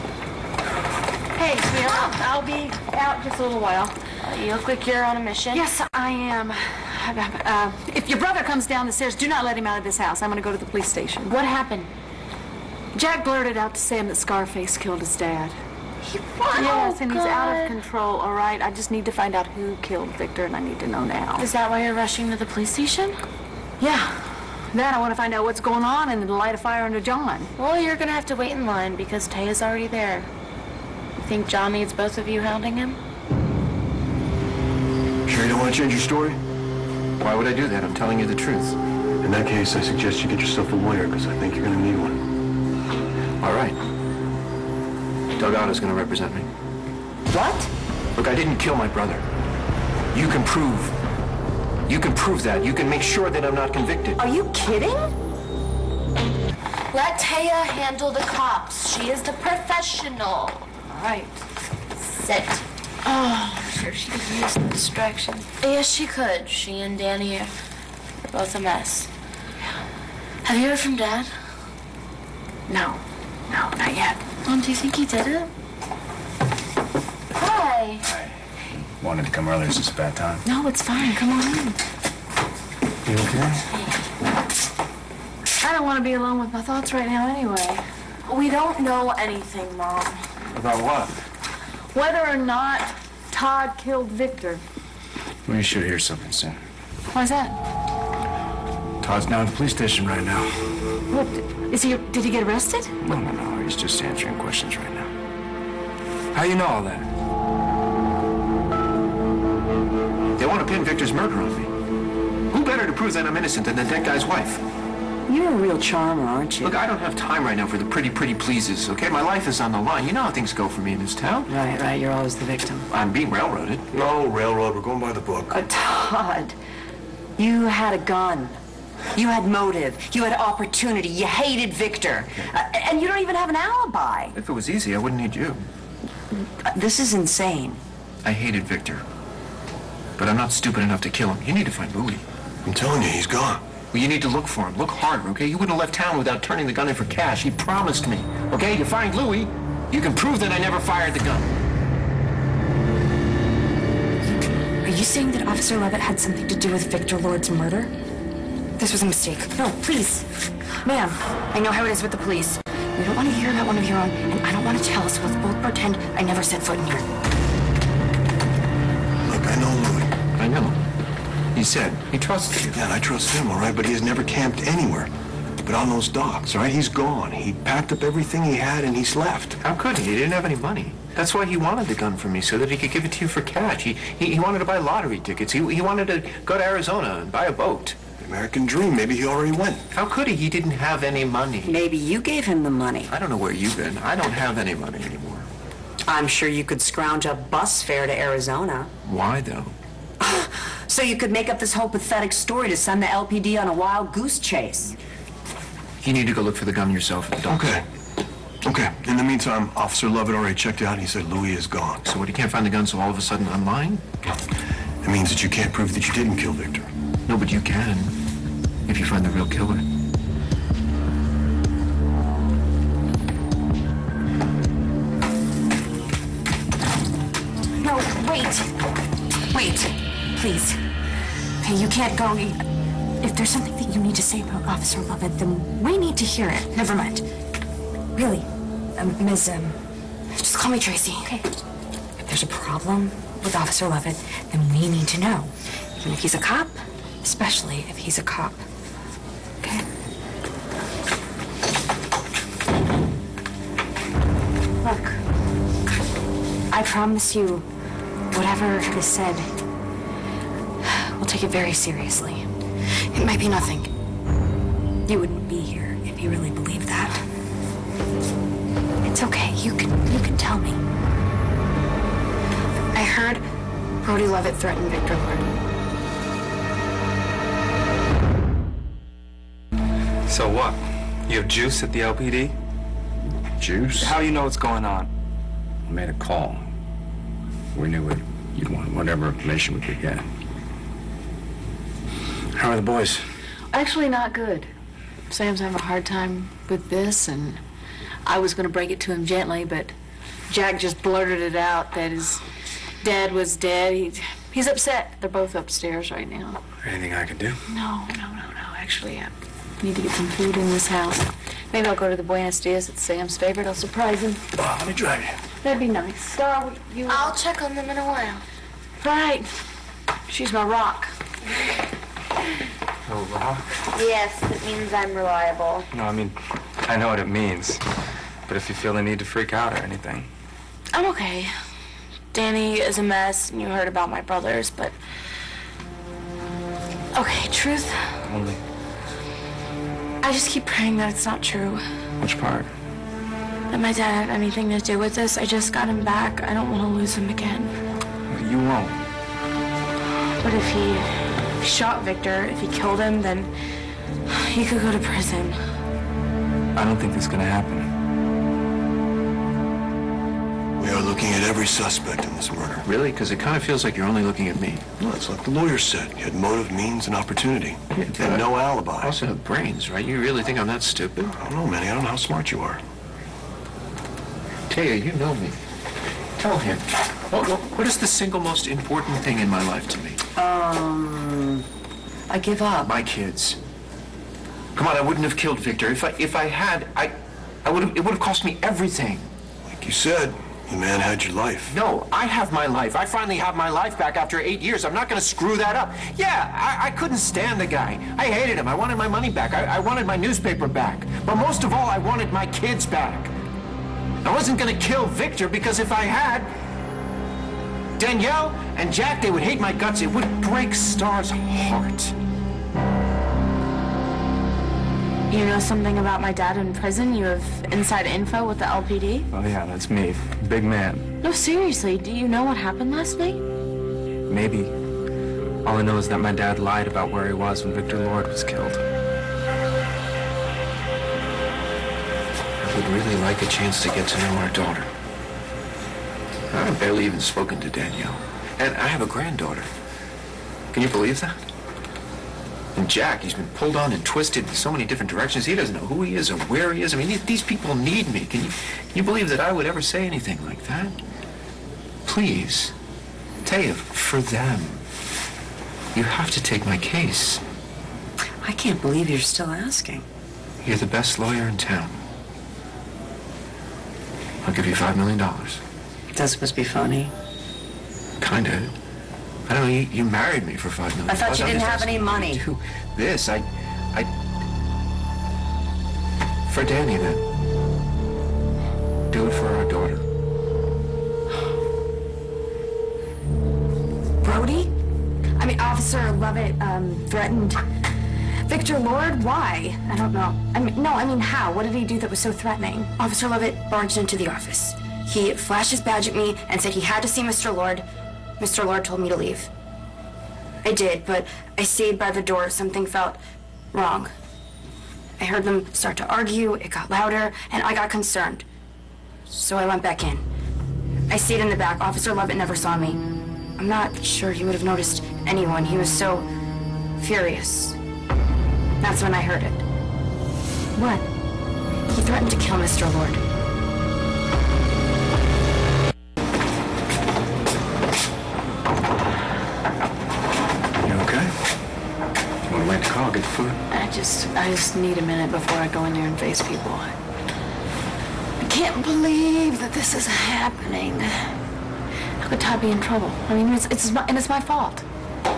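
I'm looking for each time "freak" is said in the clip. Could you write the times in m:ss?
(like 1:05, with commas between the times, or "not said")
5:29.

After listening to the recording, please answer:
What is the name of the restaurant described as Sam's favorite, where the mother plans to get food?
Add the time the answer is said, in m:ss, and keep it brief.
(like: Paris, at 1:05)
Buenos Dias, at 5:12.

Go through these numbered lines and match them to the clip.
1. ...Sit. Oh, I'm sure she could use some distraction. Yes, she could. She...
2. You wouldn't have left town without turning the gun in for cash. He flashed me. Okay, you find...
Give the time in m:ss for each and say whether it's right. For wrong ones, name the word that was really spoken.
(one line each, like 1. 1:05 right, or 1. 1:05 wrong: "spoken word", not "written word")
1. 1:01 right
2. 2:25 wrong: "promised", not "flashed".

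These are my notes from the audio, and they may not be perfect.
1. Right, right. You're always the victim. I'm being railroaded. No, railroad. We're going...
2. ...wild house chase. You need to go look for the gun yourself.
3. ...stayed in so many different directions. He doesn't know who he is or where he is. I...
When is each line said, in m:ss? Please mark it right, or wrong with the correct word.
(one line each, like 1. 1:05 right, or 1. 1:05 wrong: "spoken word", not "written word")
1. 2:01 right
2. 3:23 wrong: "goose", not "house"
3. 7:24 wrong: "twisted", not "stayed".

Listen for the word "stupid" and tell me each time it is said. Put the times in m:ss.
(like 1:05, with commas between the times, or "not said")
2:20, 6:10.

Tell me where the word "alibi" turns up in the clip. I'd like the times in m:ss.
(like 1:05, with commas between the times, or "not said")
2:13, 6:08.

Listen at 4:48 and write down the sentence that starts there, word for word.
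You'd want whatever information we could get.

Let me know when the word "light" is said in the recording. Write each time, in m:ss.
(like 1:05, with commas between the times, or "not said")
0:26.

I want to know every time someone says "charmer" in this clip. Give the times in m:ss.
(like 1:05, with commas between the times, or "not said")
1:55.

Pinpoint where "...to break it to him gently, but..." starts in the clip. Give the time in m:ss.
4:58.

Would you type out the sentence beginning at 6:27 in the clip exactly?
It would have cost me everything.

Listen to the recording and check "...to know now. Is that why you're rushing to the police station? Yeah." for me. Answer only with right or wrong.
right.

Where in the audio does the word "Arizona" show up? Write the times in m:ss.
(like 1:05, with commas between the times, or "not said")
3:06, 3:18.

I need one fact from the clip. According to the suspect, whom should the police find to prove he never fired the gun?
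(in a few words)
Louie.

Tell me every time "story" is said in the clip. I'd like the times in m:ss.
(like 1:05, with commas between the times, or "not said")
0:35, 3:22.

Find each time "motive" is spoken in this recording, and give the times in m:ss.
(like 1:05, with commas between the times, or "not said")
2:09, 6:06.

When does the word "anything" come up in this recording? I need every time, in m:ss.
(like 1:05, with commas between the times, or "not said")
1:29, 5:06, 5:29, 5:44, 7:30.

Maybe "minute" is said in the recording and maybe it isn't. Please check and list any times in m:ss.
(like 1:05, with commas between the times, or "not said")
8:55.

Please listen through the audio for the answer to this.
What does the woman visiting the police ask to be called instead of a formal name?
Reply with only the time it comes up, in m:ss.
4:00.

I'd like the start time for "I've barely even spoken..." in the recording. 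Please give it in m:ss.
7:16.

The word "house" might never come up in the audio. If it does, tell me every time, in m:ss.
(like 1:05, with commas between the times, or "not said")
0:09, 5:10.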